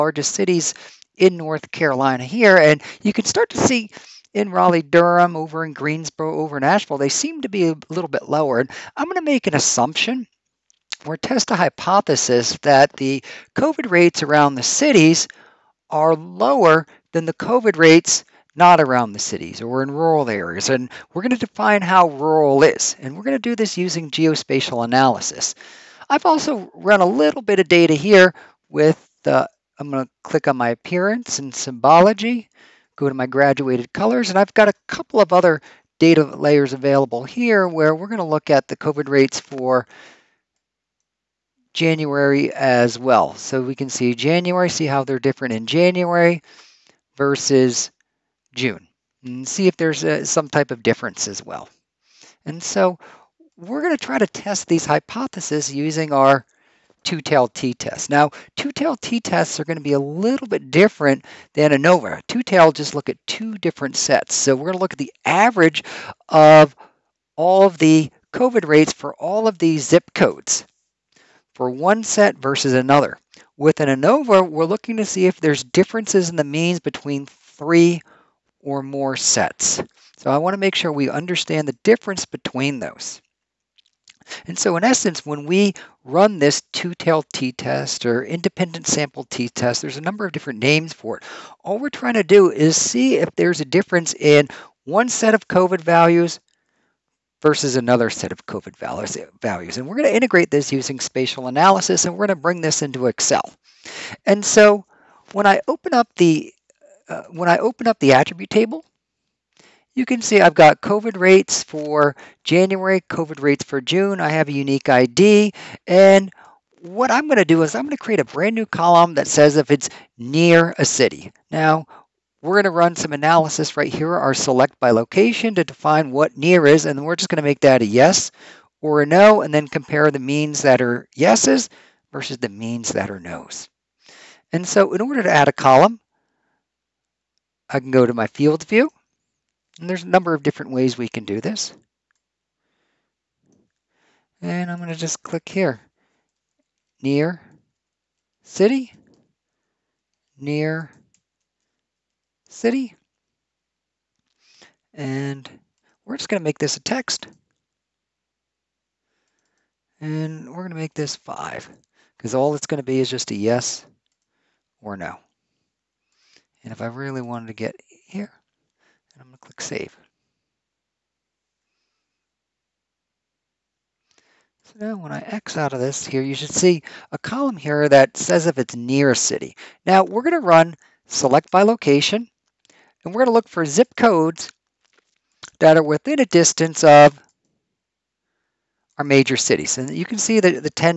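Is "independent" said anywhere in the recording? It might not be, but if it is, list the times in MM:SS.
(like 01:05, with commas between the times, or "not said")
01:28.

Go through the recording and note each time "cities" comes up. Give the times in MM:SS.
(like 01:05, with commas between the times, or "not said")
00:00, 00:14, 00:19, 03:09.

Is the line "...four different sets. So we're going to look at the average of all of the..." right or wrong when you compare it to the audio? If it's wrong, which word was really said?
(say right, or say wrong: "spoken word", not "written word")
wrong: "two", not "four".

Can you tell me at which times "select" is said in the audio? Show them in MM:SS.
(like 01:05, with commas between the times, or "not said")
02:04, 03:01.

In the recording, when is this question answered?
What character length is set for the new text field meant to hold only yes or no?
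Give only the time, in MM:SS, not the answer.
02:41.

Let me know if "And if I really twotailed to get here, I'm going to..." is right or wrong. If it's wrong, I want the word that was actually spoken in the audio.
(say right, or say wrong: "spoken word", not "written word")
wrong: "wanted", not "twotailed".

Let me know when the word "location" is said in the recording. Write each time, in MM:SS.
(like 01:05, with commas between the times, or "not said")
02:04, 03:01.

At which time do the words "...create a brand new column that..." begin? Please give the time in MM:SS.
01:58.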